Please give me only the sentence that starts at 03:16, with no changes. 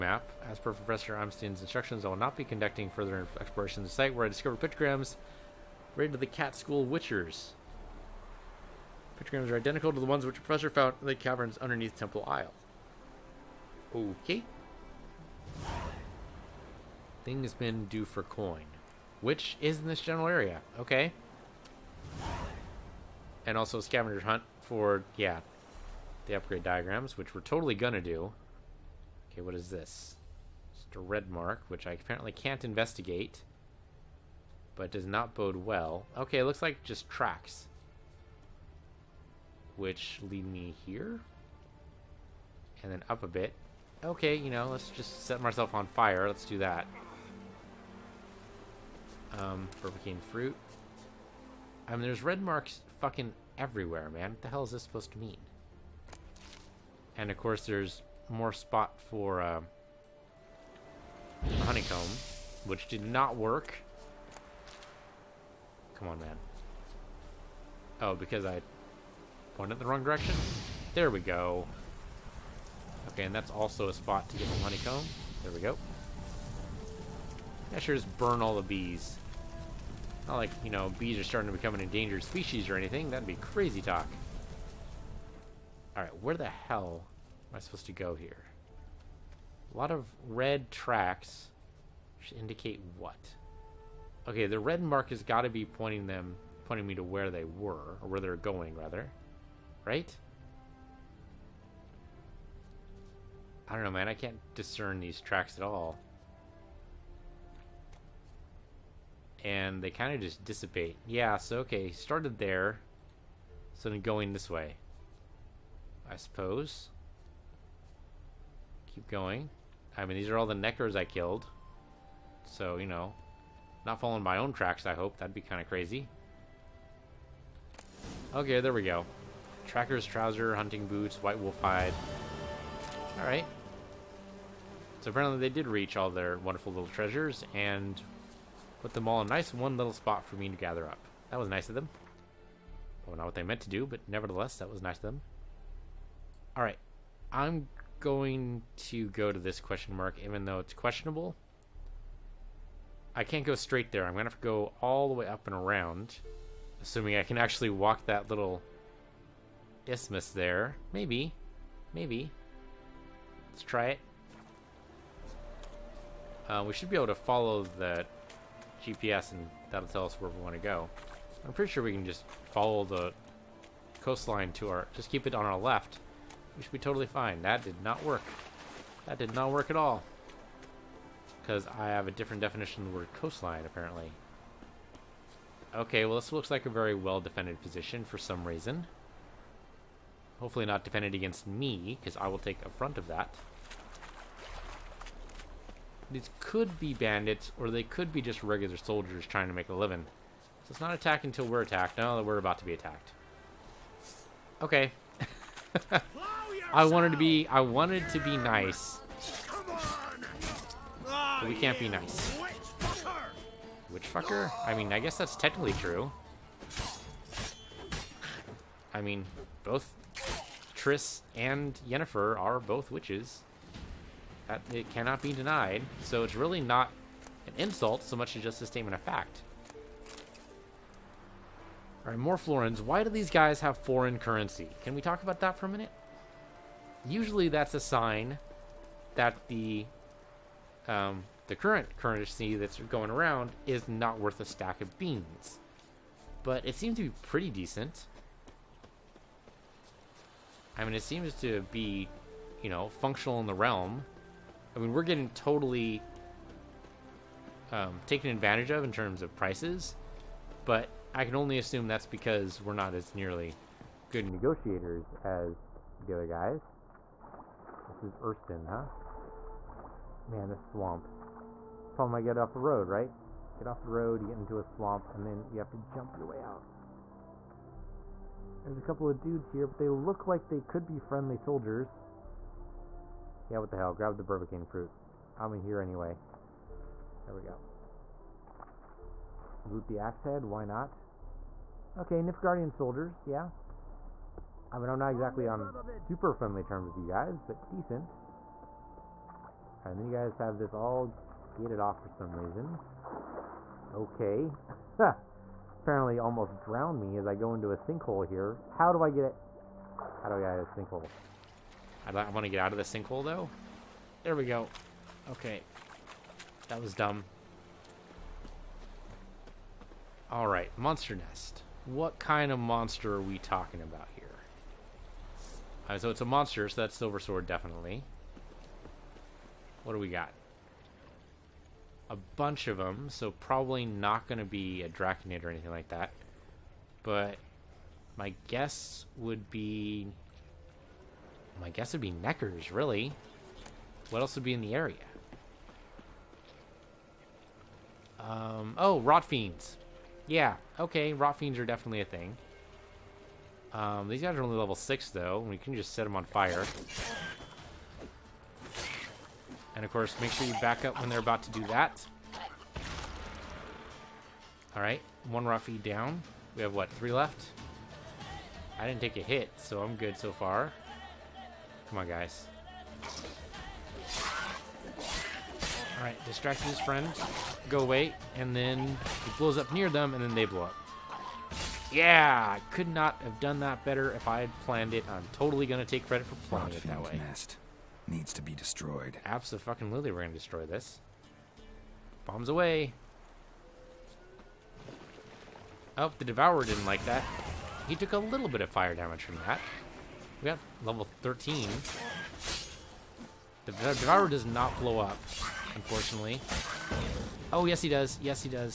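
These could be bandits, or they could be just regular soldiers trying to make a living.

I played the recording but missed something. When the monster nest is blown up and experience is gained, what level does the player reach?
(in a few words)
13.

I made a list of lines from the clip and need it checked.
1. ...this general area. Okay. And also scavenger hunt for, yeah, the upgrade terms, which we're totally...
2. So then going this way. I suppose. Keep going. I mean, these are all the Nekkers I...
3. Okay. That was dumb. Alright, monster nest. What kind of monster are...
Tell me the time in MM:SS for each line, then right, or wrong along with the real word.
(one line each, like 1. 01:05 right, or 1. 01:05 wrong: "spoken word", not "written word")
1. 00:19 wrong: "diagrams", not "terms"
2. 01:53 right
3. 05:15 right.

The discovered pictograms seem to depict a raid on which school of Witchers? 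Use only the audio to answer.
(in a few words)
Cat School.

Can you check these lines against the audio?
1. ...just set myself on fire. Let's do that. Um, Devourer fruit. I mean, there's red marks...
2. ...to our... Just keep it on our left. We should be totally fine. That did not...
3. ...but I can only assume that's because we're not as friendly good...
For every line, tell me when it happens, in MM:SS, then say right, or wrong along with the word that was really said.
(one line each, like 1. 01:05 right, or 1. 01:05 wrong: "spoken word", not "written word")
1. 00:44 wrong: "Burger", not "Devourer"
2. 02:54 right
3. 04:20 wrong: "nearly", not "friendly".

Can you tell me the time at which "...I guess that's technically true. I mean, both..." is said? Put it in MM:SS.
03:34.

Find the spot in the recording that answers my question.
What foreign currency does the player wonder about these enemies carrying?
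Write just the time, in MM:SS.
03:52.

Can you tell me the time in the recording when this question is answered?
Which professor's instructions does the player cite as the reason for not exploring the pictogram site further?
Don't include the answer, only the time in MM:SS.
00:00.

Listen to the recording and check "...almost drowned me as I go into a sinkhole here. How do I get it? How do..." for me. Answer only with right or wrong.
right.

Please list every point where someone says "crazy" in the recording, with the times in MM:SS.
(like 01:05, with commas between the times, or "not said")
01:23, 02:05.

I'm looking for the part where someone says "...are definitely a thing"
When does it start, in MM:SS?
05:51.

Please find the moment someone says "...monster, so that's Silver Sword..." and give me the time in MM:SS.
05:26.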